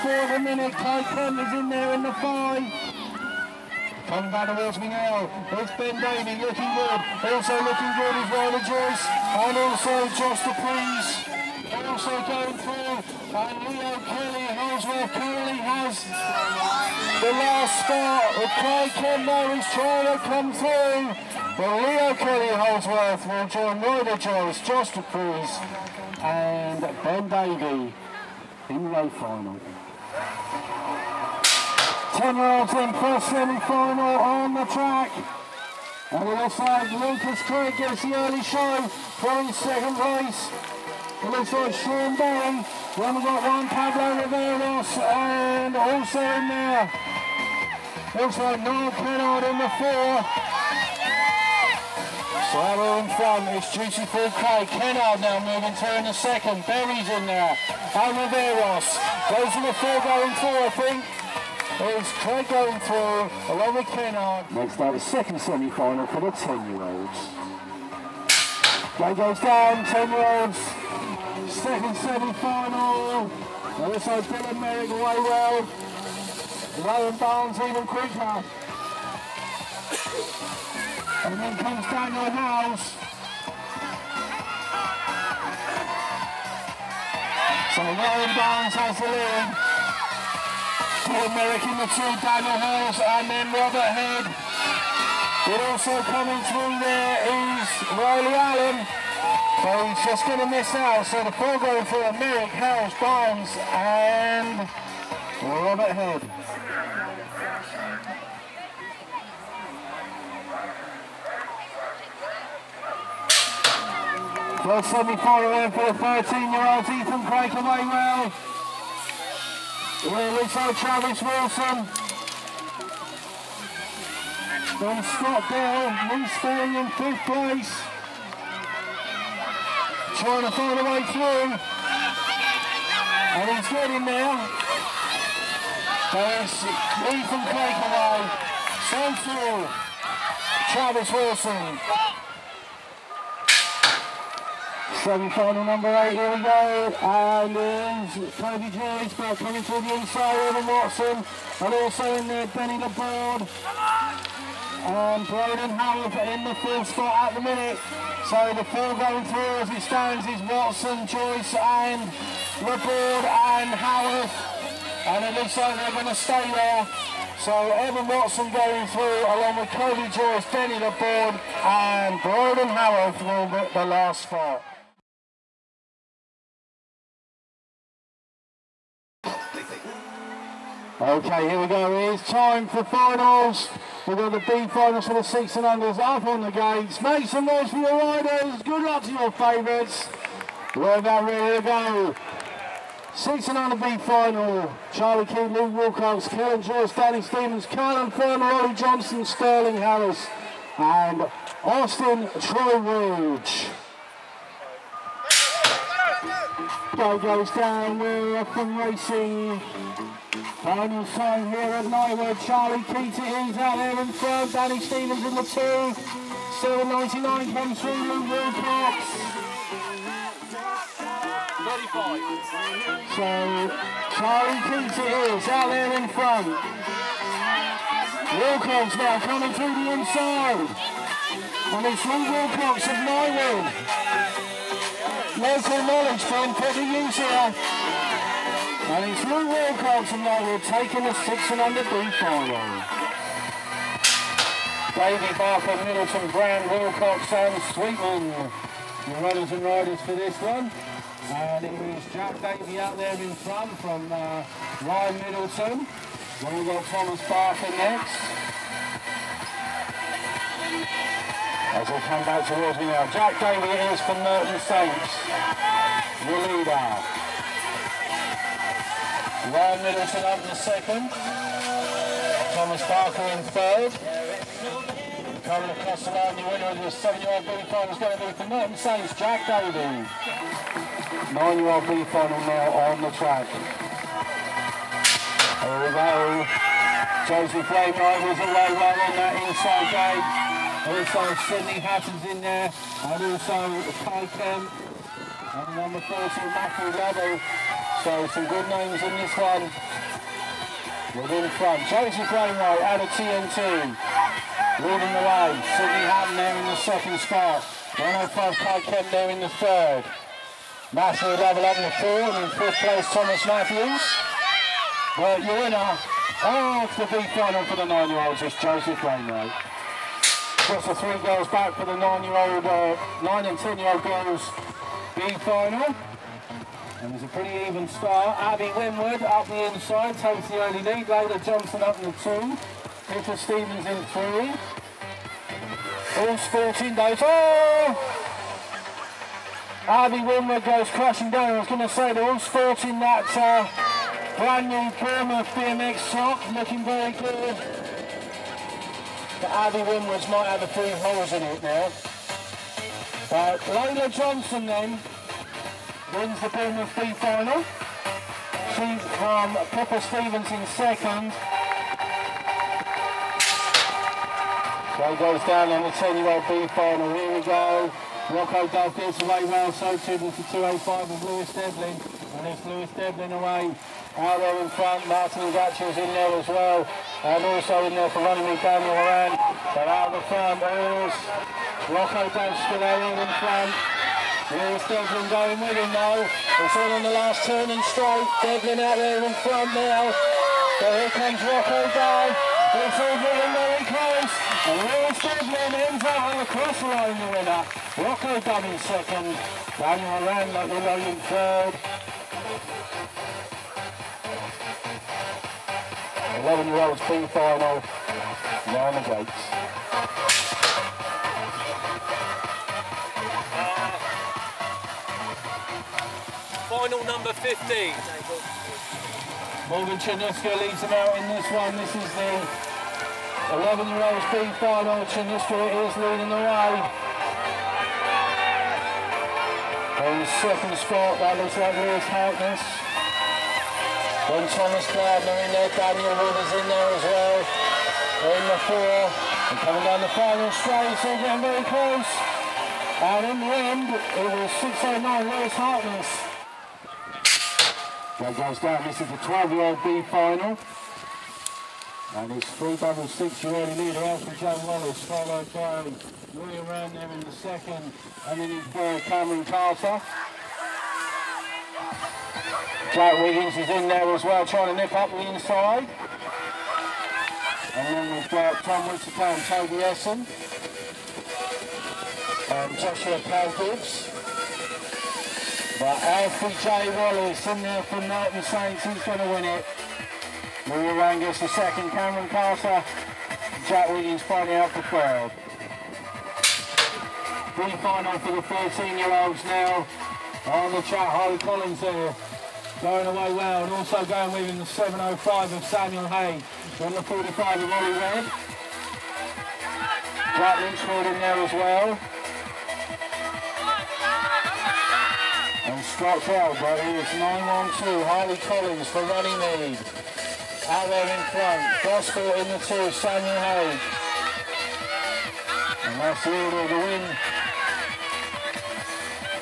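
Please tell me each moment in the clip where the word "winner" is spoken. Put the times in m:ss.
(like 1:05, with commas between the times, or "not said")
4:36, 5:15, 6:37.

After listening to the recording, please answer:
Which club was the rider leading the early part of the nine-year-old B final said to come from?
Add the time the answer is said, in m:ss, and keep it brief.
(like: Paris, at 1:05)
TNT, at 5:03.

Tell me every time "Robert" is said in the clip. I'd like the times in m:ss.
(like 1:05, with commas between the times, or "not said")
1:33, 1:45.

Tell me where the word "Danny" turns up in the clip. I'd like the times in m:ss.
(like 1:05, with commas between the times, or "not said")
3:16, 3:34.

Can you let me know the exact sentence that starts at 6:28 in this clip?
Devlin out there in front now.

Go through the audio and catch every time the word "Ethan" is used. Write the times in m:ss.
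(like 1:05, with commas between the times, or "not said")
1:56, 2:17.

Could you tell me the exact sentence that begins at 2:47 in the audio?
So Evan Watson going through along with Cody Joyce, Benny LeBoard and Broden Howell for the last four.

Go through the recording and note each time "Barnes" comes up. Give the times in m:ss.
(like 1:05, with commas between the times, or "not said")
1:17, 1:28, 1:43.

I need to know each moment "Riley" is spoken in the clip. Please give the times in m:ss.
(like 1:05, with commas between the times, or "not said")
1:37.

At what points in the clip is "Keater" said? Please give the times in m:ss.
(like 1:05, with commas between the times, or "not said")
3:32, 3:44.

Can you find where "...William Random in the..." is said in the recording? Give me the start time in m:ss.
7:36.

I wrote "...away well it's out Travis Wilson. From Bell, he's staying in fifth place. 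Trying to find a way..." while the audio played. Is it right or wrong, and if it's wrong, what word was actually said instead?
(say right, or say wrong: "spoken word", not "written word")
right.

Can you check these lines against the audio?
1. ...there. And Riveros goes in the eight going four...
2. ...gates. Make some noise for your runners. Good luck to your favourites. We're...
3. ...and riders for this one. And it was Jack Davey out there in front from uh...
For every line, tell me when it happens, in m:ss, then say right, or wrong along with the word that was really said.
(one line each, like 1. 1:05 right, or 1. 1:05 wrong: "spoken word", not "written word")
1. 0:57 wrong: "four", not "eight"
2. 3:06 wrong: "riders", not "runners"
3. 4:09 right.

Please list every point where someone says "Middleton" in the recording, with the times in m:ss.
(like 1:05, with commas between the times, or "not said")
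4:05, 4:15, 4:29.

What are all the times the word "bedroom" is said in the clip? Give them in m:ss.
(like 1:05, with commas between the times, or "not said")
not said.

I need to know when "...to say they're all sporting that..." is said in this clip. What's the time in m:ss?
5:41.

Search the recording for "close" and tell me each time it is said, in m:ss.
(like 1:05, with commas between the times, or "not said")
6:33, 7:21.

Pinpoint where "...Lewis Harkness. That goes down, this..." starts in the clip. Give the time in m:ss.
7:25.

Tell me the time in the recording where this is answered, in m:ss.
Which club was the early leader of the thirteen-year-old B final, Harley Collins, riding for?
8:29.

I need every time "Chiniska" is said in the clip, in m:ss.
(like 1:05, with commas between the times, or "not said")
6:59, 7:05.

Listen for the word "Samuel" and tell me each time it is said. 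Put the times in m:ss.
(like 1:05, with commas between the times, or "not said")
8:15, 8:32.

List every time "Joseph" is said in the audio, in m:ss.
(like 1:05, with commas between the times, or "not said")
4:47, 5:18.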